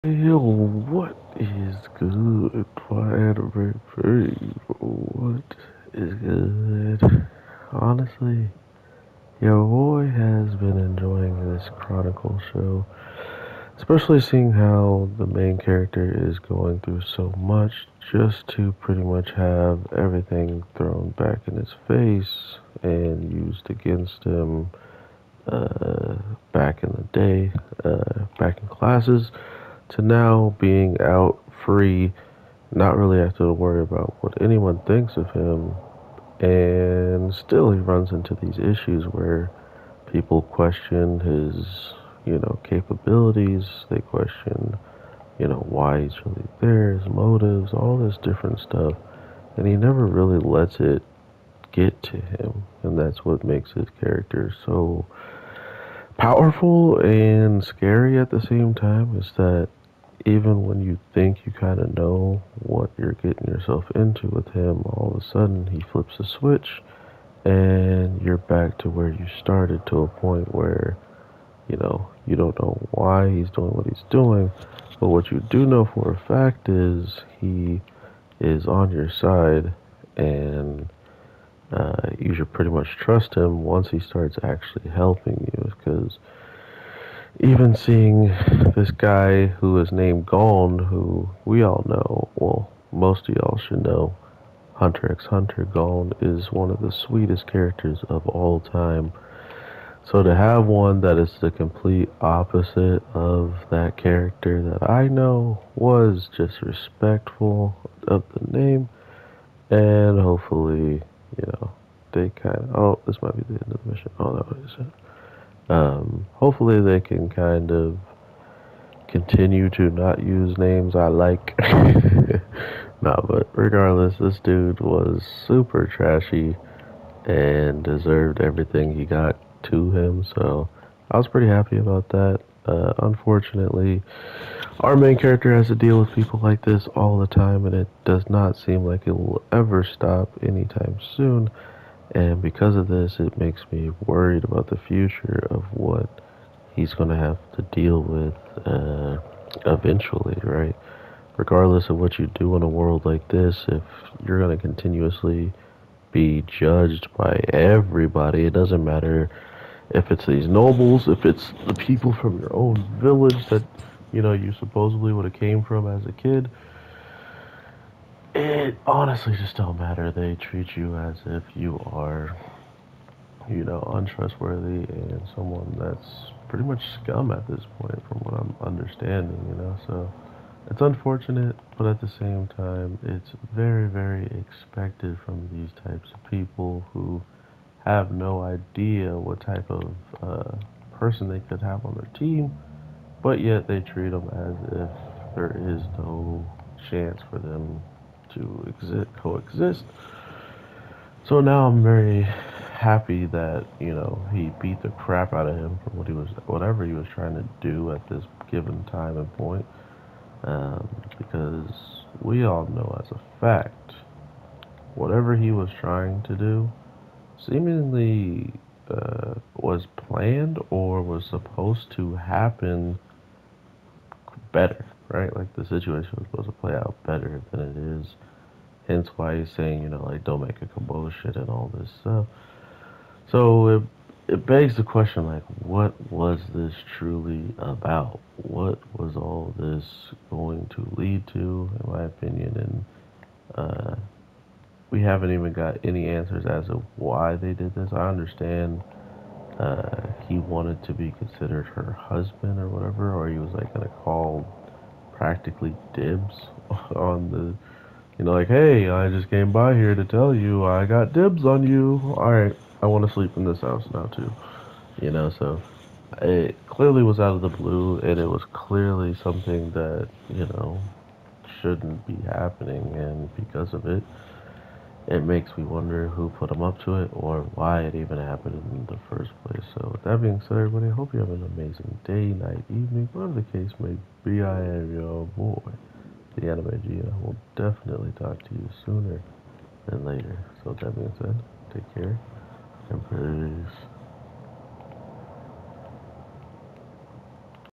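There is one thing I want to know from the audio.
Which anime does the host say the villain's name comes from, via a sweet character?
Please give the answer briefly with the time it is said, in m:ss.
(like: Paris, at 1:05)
Hunter x Hunter, at 1:34.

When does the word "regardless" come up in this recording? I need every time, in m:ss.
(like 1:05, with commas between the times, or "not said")
2:03, 2:31.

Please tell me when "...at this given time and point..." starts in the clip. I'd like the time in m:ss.
3:27.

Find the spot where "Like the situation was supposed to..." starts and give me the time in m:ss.
3:45.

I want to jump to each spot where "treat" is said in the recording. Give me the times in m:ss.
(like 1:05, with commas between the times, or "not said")
2:50, 3:13.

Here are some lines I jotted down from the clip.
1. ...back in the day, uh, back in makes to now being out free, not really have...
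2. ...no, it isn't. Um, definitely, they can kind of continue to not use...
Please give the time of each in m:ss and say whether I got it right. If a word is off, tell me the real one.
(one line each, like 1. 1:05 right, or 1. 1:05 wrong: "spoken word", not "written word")
1. 0:26 wrong: "classes", not "makes"
2. 1:54 wrong: "hopefully", not "definitely".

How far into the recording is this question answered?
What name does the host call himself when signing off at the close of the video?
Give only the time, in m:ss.
4:46.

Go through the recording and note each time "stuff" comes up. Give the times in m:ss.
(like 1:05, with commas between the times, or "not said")
0:48, 3:52.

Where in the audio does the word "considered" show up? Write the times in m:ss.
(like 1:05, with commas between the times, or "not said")
4:11.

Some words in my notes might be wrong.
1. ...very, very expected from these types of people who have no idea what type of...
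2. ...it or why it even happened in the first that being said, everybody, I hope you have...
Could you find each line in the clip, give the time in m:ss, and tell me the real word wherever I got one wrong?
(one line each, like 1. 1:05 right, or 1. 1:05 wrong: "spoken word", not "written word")
1. 3:03 right
2. 4:36 right.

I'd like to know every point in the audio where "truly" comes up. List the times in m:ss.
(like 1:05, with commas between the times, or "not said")
3:56.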